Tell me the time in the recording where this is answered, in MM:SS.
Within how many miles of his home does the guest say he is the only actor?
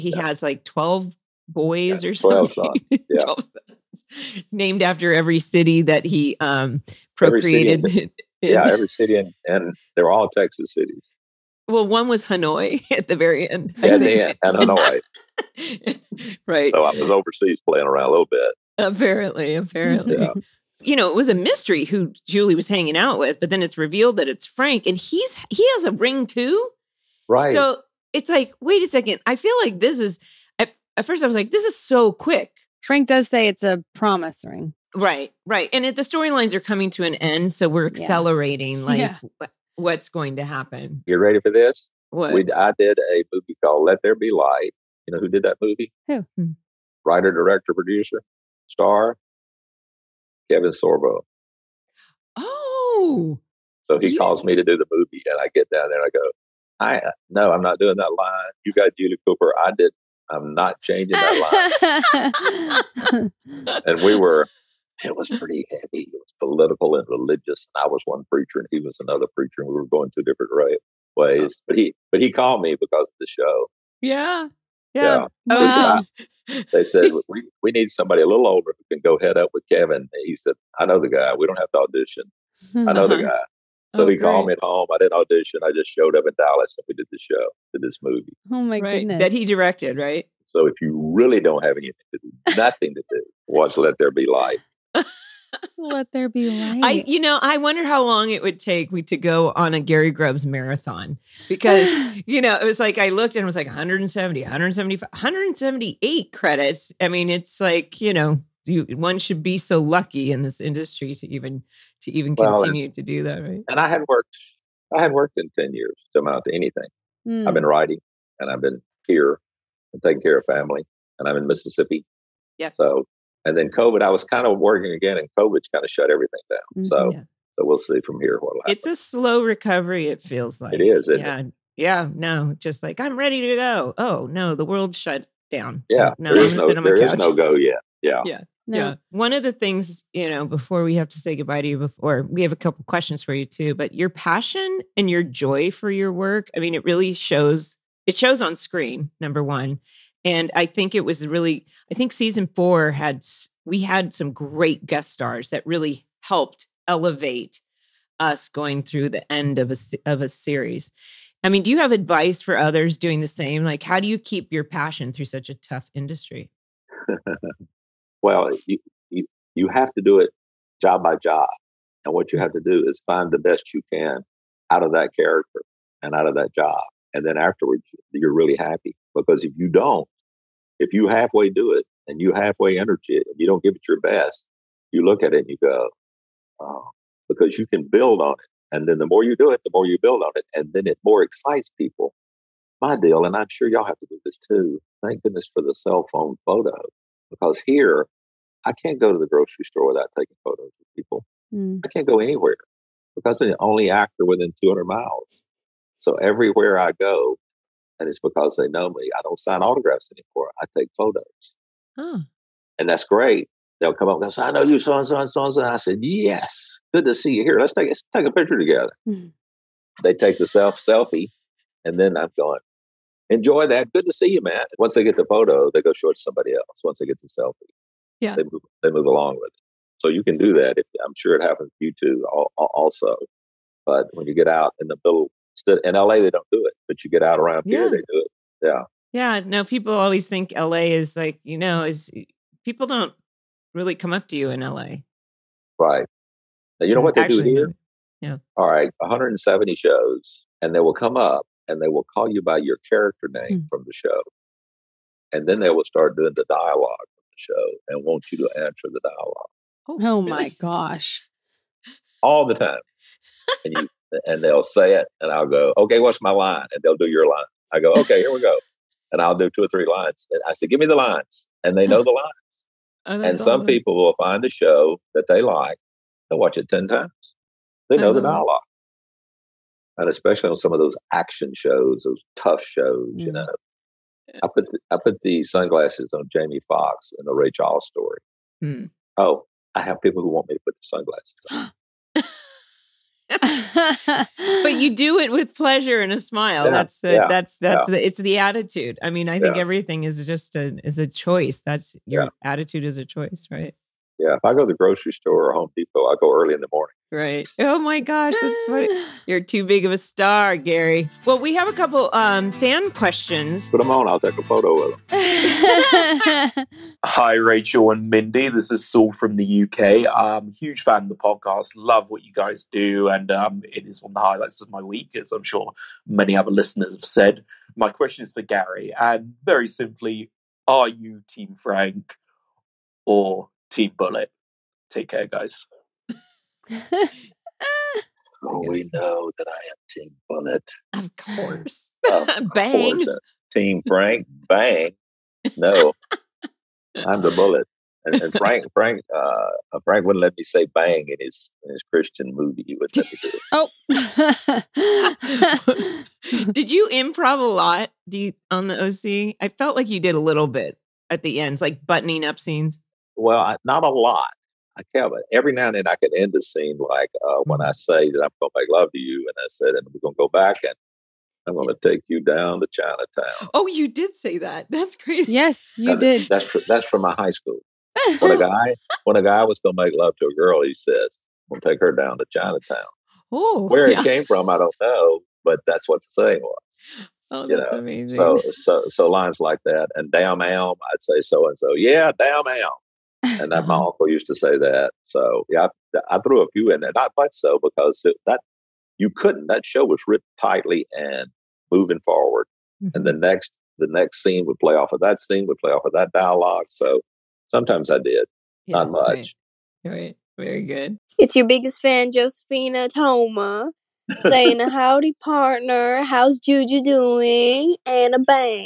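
03:24.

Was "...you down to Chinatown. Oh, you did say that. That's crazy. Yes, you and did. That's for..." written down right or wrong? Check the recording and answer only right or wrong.
right.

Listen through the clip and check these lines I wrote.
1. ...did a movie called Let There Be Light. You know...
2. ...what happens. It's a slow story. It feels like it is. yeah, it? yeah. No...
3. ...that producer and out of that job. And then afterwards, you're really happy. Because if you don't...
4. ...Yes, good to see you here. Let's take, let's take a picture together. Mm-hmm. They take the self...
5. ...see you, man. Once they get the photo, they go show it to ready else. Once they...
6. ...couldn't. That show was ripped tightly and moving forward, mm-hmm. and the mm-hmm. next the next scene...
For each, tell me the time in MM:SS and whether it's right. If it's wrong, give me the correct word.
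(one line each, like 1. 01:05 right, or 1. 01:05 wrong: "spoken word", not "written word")
1. 00:42 right
2. 02:08 wrong: "recovery", not "story"
3. 02:54 wrong: "character", not "producer"
4. 03:36 right
5. 03:44 wrong: "somebody", not "ready"
6. 06:39 right.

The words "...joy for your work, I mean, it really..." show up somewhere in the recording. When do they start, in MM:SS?
02:25.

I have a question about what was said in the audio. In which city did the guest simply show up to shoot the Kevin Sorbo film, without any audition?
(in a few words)
Dallas.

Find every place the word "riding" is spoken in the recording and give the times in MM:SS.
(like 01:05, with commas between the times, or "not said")
not said.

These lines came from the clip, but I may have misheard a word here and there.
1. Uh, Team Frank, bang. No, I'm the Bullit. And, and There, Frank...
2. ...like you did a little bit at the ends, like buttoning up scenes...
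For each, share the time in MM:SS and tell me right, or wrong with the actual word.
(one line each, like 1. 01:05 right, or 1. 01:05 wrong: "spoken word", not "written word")
1. 05:43 wrong: "Frank", not "There"
2. 05:59 right.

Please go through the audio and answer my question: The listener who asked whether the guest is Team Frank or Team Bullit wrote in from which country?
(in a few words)
UK.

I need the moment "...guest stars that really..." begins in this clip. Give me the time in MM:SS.
02:34.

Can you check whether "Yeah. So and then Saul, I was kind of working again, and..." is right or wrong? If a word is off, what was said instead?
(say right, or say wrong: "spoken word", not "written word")
wrong: "COVID", not "Saul".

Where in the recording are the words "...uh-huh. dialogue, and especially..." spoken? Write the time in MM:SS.
04:38.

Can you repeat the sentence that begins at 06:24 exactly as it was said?
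it came from, I don't know, but that's what the saying was.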